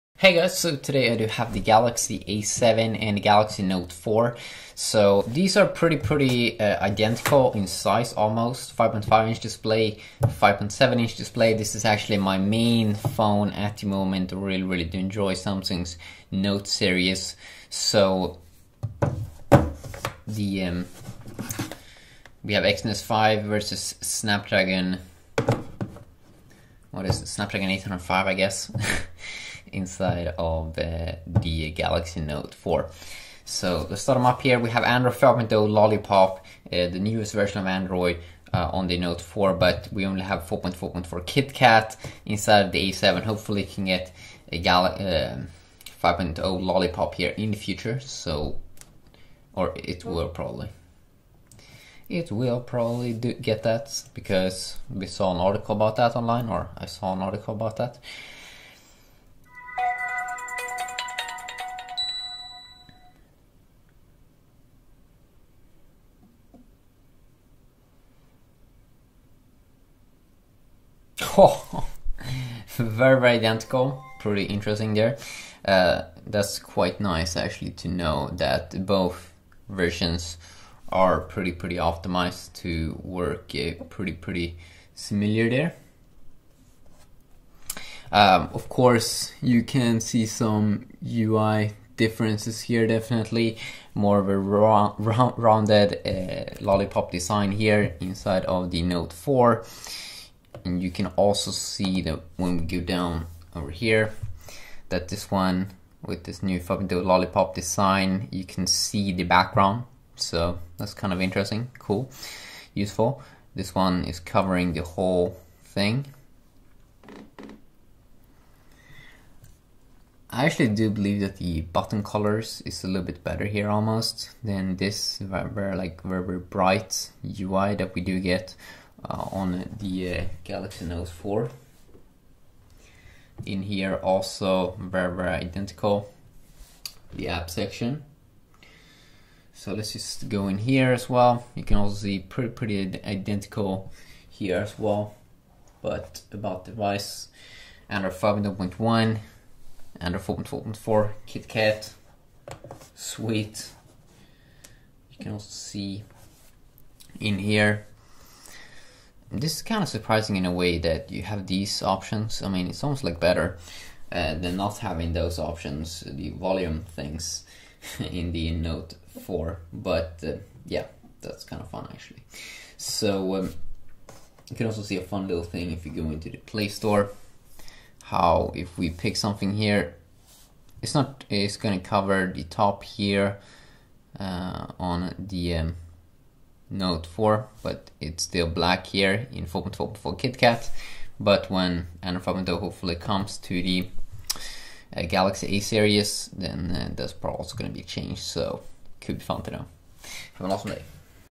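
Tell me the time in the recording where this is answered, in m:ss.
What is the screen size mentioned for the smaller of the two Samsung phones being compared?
0:08.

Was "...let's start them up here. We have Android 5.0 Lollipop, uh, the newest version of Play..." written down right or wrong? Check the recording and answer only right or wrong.
wrong.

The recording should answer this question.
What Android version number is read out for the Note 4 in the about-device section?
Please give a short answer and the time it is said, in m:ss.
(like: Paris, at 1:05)
5.1, at 2:27.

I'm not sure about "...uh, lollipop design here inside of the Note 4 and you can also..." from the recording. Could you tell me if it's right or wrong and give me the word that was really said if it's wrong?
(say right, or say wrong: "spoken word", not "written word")
right.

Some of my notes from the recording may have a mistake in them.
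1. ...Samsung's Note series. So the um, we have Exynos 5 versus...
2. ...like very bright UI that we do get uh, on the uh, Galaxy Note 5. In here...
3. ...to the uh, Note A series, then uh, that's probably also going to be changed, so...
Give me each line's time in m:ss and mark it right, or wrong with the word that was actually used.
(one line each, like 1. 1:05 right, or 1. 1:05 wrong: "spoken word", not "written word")
1. 0:15 right
2. 2:05 wrong: "4", not "5"
3. 3:13 wrong: "Galaxy", not "Note".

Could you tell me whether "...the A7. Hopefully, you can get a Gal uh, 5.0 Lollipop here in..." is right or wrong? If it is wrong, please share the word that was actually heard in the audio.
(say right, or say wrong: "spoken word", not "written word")
right.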